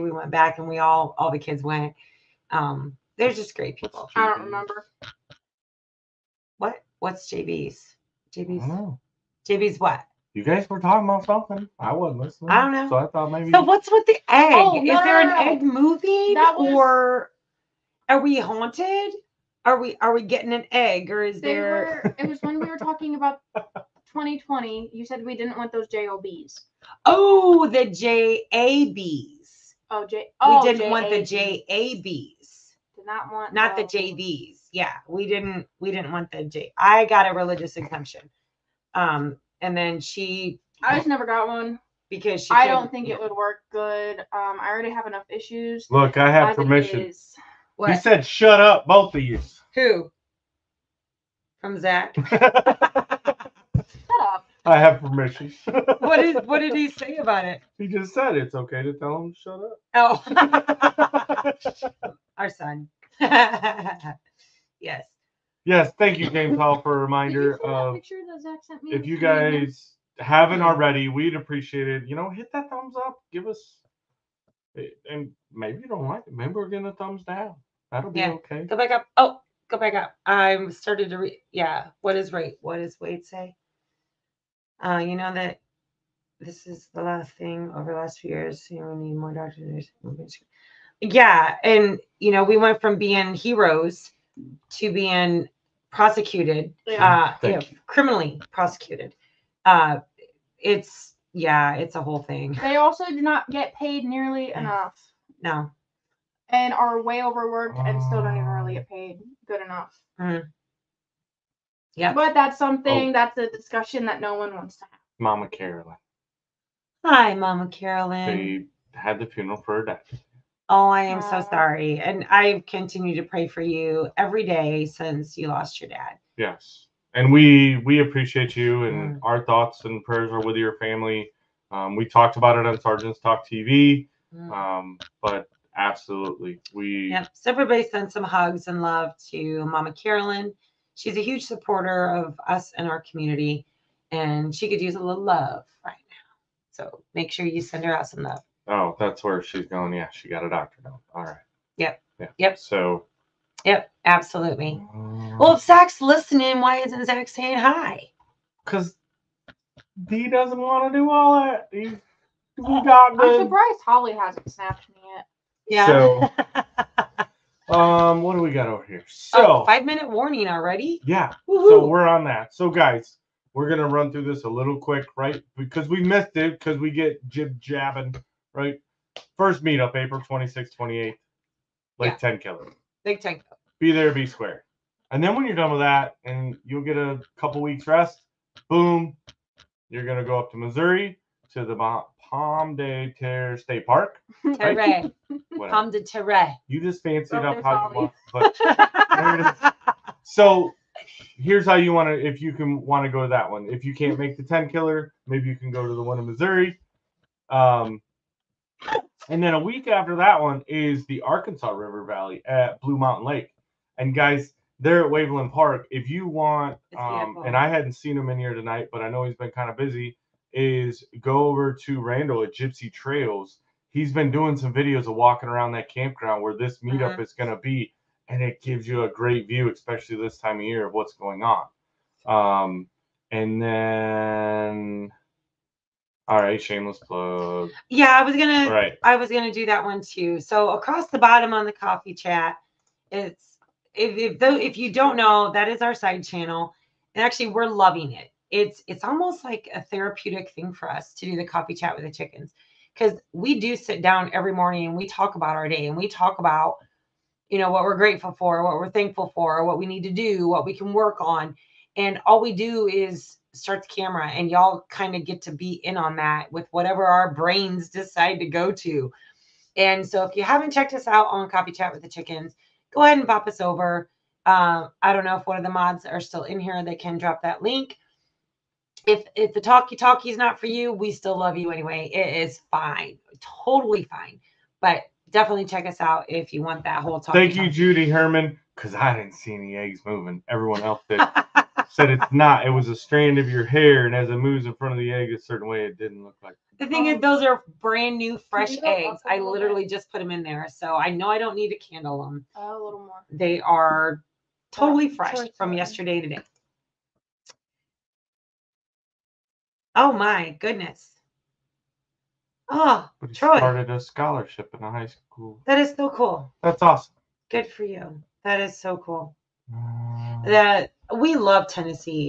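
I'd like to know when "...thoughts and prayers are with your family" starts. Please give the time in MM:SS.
02:09.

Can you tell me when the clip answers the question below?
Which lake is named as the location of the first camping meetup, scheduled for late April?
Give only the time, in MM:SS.
03:03.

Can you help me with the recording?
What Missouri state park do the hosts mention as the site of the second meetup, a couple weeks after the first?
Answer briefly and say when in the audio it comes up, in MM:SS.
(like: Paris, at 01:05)
Pomme de Terre State Park, at 03:12.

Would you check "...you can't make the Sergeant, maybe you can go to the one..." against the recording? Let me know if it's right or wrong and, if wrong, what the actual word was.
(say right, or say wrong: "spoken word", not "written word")
wrong: "Tenkiller", not "Sergeant".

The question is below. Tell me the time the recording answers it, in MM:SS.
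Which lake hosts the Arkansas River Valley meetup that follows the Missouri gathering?
03:32.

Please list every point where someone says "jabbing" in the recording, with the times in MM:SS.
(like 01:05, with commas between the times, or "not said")
02:57.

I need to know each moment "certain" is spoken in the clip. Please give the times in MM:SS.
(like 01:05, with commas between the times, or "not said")
04:55.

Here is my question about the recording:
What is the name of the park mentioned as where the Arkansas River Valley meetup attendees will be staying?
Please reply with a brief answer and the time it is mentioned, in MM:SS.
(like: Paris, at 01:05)
Waveland Park, at 03:35.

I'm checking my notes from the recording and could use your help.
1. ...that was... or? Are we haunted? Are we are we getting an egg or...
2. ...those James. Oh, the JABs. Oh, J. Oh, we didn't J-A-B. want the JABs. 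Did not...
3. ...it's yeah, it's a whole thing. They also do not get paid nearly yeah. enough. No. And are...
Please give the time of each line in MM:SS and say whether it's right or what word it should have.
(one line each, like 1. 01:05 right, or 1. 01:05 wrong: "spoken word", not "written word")
1. 00:16 right
2. 00:25 wrong: "JOBs", not "James"
3. 01:40 right.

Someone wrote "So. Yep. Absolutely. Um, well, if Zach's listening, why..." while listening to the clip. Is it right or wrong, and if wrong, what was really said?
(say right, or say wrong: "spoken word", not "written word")
right.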